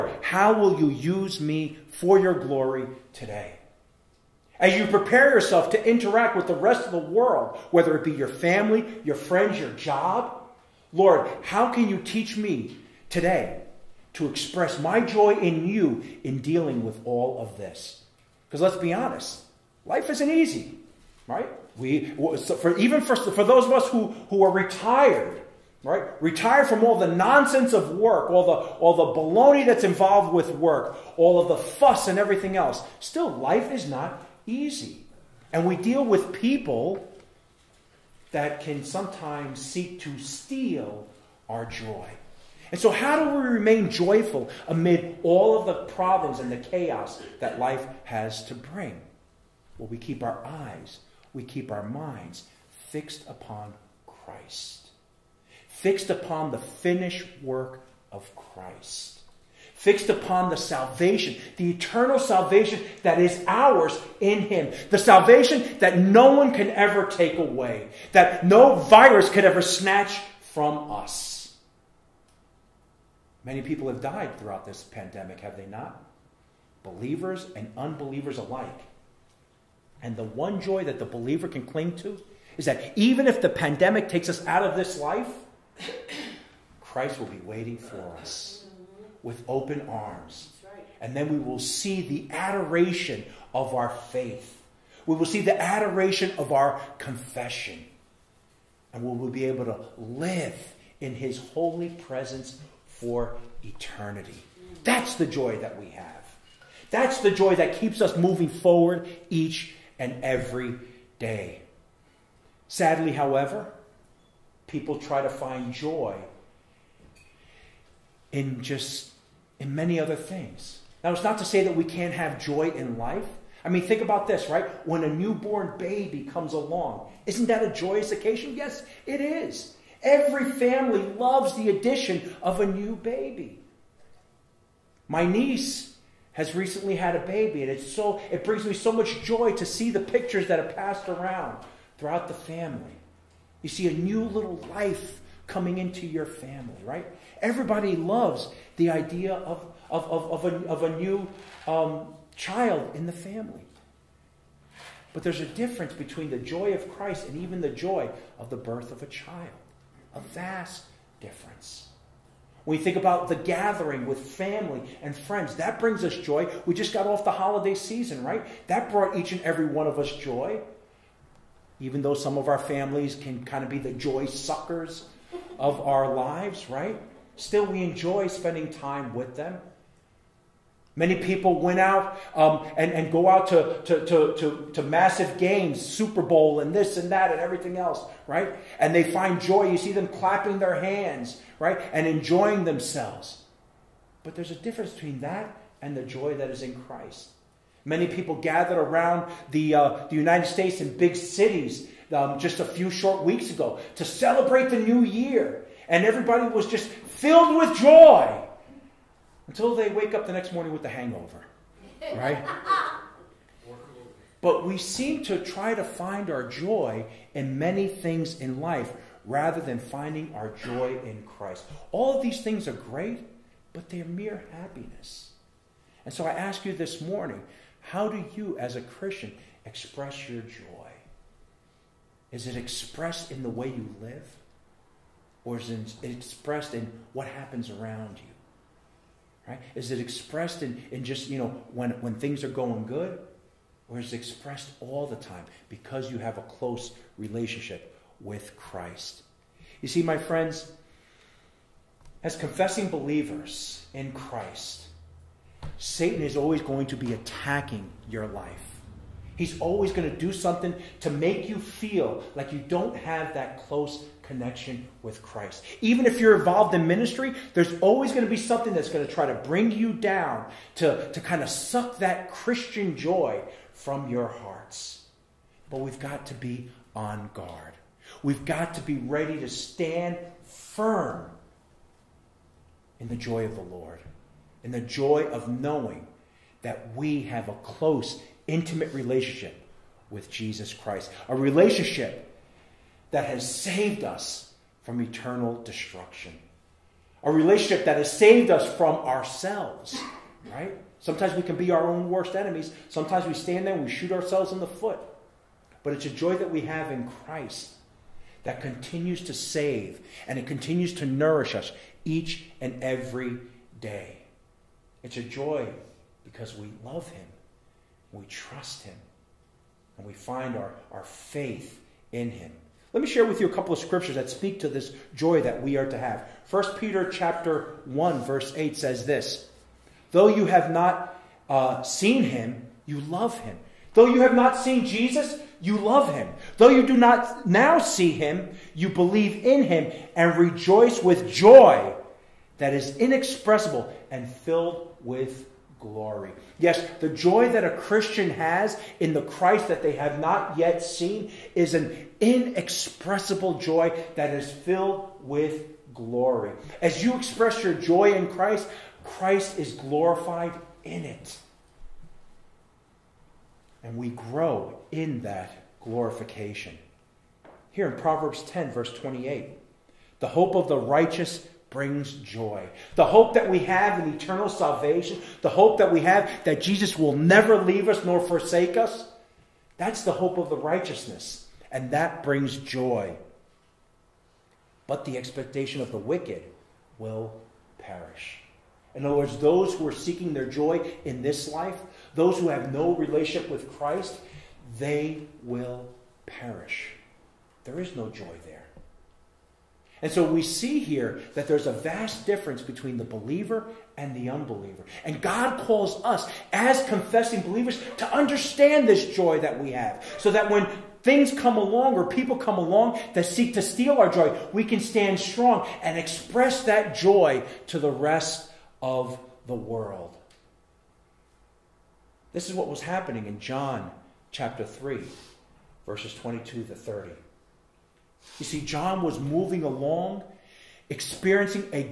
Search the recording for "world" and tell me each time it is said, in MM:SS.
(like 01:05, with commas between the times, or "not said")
00:06, 06:59.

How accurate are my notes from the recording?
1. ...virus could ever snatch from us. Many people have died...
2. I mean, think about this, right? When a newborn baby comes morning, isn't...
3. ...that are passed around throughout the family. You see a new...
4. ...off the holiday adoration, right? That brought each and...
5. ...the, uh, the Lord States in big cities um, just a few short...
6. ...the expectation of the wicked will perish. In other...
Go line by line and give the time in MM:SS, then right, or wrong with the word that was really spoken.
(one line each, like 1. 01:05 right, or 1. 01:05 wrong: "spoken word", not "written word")
1. 01:08 right
2. 02:03 wrong: "along", not "morning"
3. 02:20 right
4. 02:47 wrong: "season", not "adoration"
5. 03:19 wrong: "United", not "Lord"
6. 06:25 right.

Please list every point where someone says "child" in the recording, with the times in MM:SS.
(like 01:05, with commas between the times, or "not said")
02:32, 02:39.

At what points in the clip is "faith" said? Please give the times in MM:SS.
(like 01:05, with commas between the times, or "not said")
01:33, 05:21.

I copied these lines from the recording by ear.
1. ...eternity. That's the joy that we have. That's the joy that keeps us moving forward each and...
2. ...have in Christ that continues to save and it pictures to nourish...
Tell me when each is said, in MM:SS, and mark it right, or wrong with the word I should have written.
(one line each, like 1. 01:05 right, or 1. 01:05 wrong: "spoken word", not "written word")
1. 01:43 right
2. 05:06 wrong: "continues", not "pictures".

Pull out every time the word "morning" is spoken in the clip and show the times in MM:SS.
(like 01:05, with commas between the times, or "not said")
03:30, 03:47.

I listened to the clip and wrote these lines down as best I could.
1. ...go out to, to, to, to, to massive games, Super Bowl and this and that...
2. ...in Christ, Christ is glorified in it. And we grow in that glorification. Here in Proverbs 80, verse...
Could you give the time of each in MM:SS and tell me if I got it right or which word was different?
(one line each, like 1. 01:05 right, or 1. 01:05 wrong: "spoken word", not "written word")
1. 03:03 right
2. 05:58 wrong: "10", not "80".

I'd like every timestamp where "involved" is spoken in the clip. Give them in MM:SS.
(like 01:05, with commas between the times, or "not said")
00:29, 04:26.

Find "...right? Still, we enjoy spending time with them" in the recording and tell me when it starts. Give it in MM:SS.
02:56.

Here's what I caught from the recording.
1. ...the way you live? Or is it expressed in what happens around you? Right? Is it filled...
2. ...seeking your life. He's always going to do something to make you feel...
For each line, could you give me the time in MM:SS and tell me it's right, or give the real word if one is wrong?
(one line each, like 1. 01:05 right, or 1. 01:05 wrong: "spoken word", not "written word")
1. 03:53 wrong: "expressed", not "filled"
2. 04:17 wrong: "attacking", not "seeking".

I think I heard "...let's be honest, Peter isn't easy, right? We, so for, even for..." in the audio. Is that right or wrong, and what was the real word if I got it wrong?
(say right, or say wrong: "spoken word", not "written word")
wrong: "Life", not "Peter".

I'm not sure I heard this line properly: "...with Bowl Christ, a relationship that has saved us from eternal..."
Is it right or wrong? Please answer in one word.
wrong.